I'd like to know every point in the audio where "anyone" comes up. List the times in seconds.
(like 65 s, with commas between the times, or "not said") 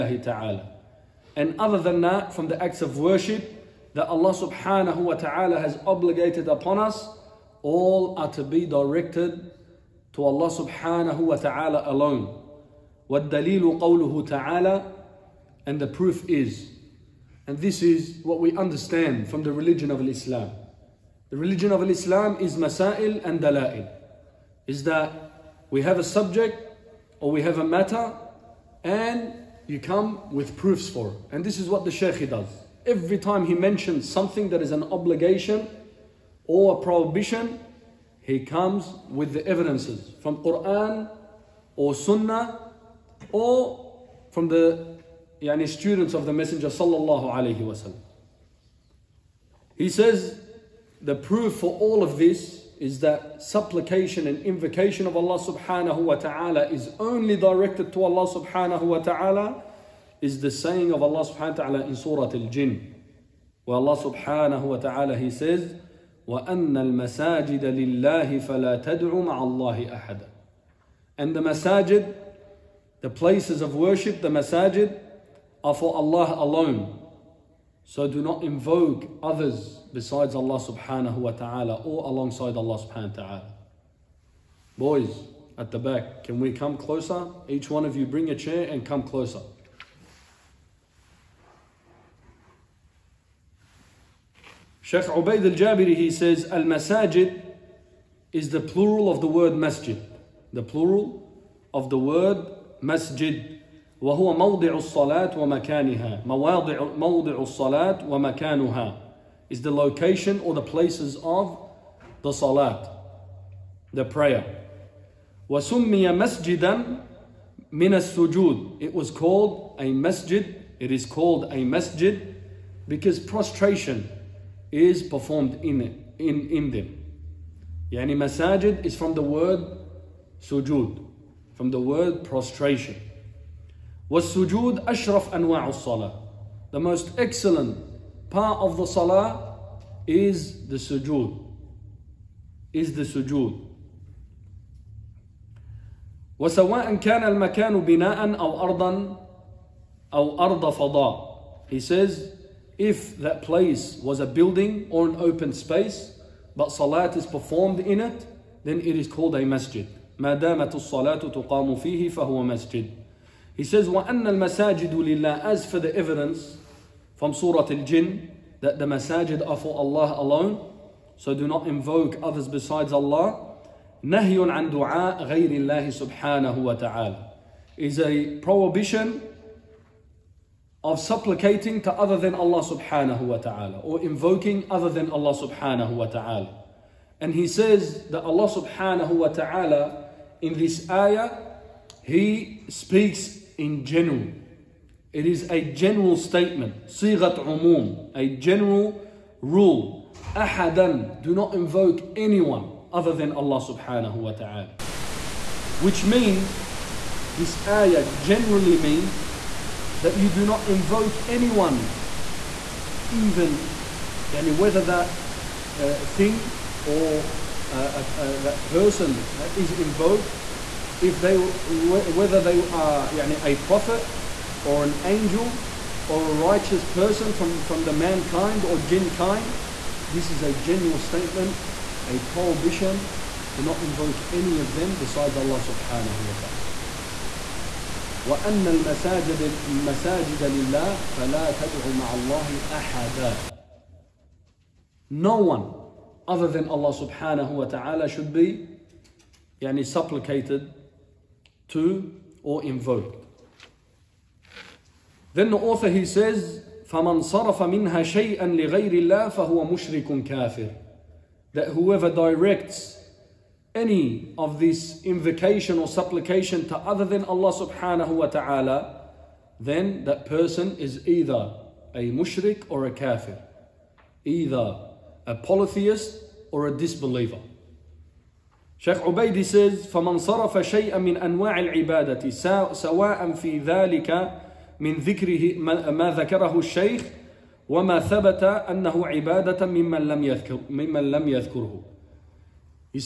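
202 s, 211 s.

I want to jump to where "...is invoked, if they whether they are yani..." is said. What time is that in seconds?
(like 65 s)
219 s.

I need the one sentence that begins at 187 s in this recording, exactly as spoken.
And he says that Allah subhanahu wa ta'ala in this ayah, he speaks in general.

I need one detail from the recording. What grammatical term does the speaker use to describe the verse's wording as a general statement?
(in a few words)
Sigat umum.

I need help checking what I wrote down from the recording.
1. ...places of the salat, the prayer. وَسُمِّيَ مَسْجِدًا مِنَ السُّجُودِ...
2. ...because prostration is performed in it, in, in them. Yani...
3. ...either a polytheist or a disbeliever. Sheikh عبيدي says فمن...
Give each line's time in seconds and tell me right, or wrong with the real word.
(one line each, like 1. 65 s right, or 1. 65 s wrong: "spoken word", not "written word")
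1. 110 s right
2. 122 s right
3. 274 s right.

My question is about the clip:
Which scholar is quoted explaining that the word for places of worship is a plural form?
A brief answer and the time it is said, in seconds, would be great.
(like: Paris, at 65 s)
Sheikh Ubaid al-Jabiri, at 94 s.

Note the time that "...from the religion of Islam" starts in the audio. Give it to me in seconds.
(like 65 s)
19 s.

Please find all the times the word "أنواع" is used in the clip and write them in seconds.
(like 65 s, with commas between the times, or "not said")
135 s, 281 s.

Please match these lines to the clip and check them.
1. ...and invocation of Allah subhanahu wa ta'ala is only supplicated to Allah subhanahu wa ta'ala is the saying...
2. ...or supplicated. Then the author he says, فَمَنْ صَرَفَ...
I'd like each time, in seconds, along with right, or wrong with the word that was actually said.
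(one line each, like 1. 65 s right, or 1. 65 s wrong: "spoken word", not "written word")
1. 54 s wrong: "directed", not "supplicated"
2. 252 s wrong: "invoked", not "supplicated".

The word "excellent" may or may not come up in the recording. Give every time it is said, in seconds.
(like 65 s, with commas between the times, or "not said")
137 s.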